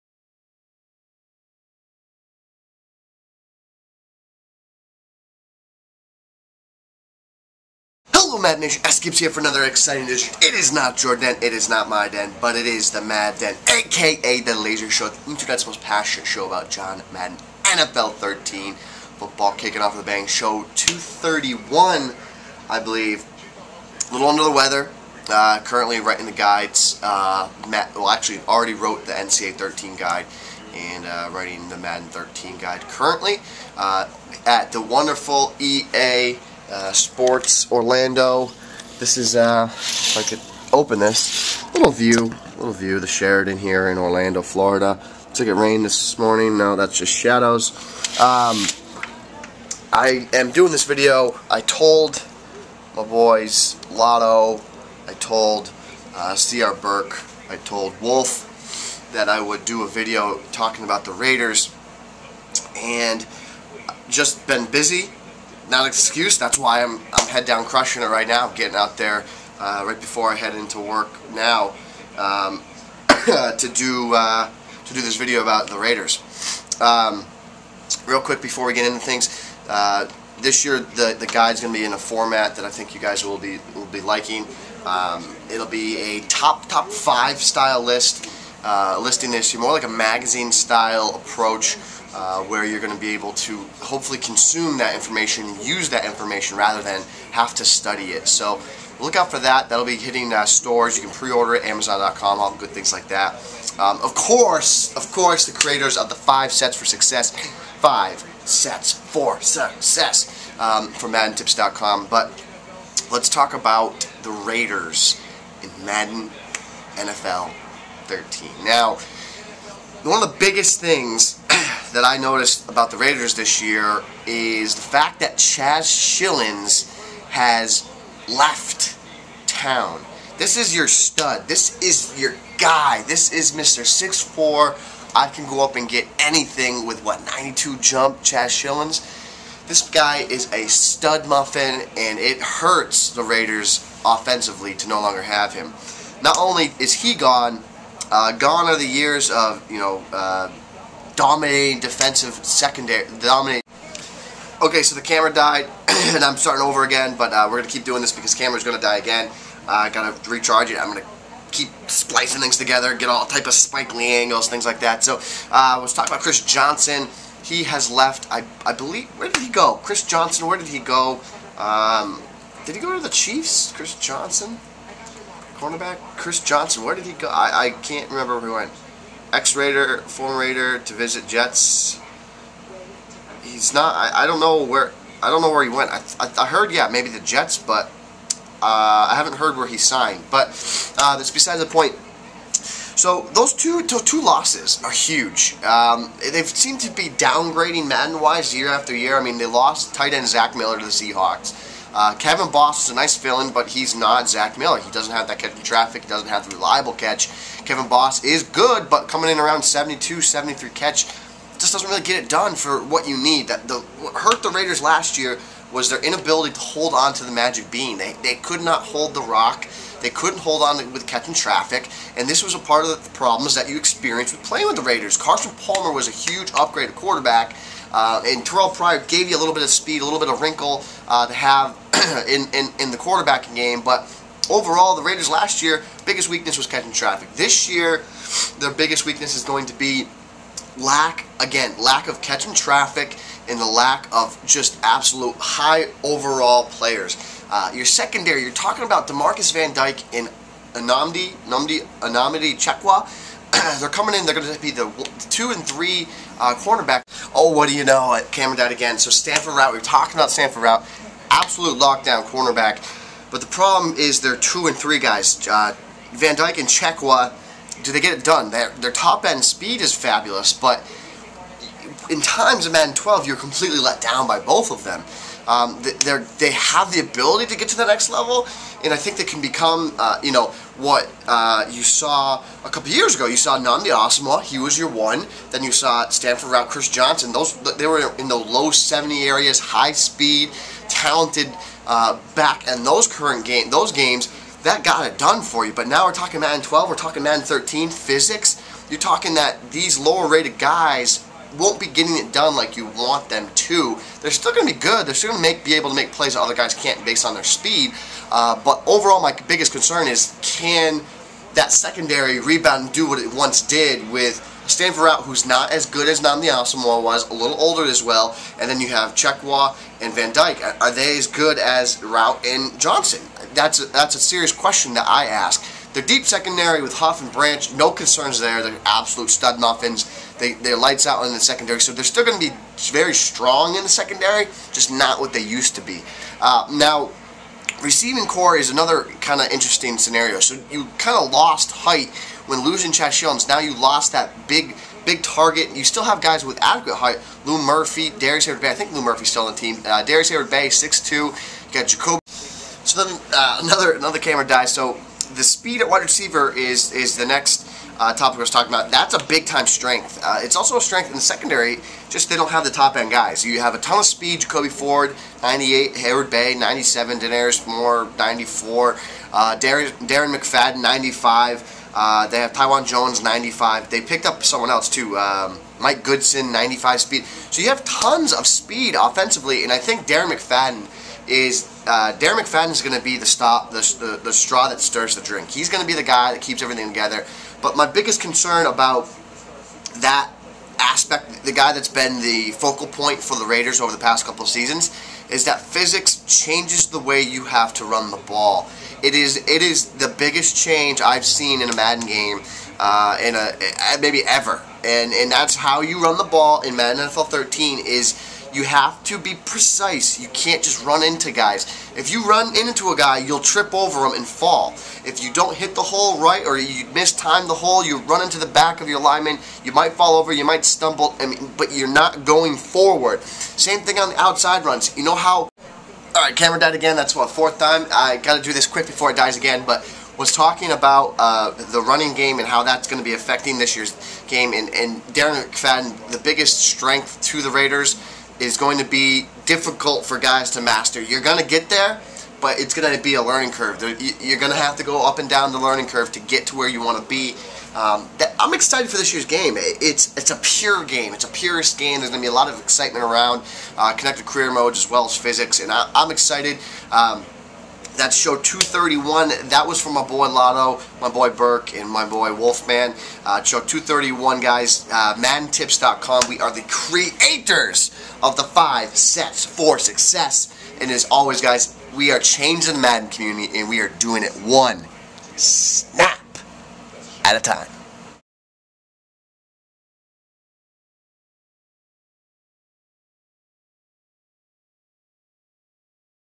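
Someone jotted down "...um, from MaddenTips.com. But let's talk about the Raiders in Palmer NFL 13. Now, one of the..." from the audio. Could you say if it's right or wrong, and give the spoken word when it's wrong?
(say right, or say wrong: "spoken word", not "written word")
wrong: "Madden", not "Palmer".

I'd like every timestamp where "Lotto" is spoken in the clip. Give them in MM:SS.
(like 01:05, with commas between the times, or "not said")
00:53, 07:40.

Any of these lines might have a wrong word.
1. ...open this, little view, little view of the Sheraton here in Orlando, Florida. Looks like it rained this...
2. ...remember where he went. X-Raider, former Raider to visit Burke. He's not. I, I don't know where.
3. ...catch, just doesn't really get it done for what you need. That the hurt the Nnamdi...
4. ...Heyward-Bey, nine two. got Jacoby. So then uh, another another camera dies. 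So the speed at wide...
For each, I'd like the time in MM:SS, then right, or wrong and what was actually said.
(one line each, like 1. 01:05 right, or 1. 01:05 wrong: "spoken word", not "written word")
1. 00:40 right
2. 02:58 wrong: "Jets", not "Burke"
3. 03:30 wrong: "Raiders", not "Nnamdi"
4. 05:50 wrong: "six", not "nine".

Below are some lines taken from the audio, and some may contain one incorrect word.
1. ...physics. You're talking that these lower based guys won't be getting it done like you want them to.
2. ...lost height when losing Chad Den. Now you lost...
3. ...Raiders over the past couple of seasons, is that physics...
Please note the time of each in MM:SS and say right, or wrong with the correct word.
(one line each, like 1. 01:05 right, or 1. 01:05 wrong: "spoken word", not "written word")
1. 04:57 wrong: "rated", not "based"
2. 05:41 wrong: "Jones", not "Den"
3. 06:33 right.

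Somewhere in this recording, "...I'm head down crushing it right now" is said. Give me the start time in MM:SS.
01:07.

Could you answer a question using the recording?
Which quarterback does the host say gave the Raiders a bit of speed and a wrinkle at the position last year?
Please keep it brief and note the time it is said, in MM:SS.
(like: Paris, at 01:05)
Terrell Pryor, at 03:48.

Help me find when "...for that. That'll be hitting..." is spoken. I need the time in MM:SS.
01:39.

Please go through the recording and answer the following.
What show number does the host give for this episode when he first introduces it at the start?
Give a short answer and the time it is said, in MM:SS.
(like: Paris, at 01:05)
231, at 00:20.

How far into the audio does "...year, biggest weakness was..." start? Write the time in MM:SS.
03:55.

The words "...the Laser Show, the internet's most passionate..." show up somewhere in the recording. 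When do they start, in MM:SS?
00:14.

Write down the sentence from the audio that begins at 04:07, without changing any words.
Uh, your secondary, you're talking about Demarcus Van Dyke and Anamdi, Anamdi, Anamdi Chekwa.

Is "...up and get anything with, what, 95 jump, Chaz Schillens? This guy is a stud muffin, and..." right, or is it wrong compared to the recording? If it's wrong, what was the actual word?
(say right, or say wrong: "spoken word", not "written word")
wrong: "92", not "95".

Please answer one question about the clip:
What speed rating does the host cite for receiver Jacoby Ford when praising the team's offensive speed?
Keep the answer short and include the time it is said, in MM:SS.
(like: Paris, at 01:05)
98, at 06:04.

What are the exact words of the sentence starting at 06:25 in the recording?
He's going to be the guy that keeps everything together.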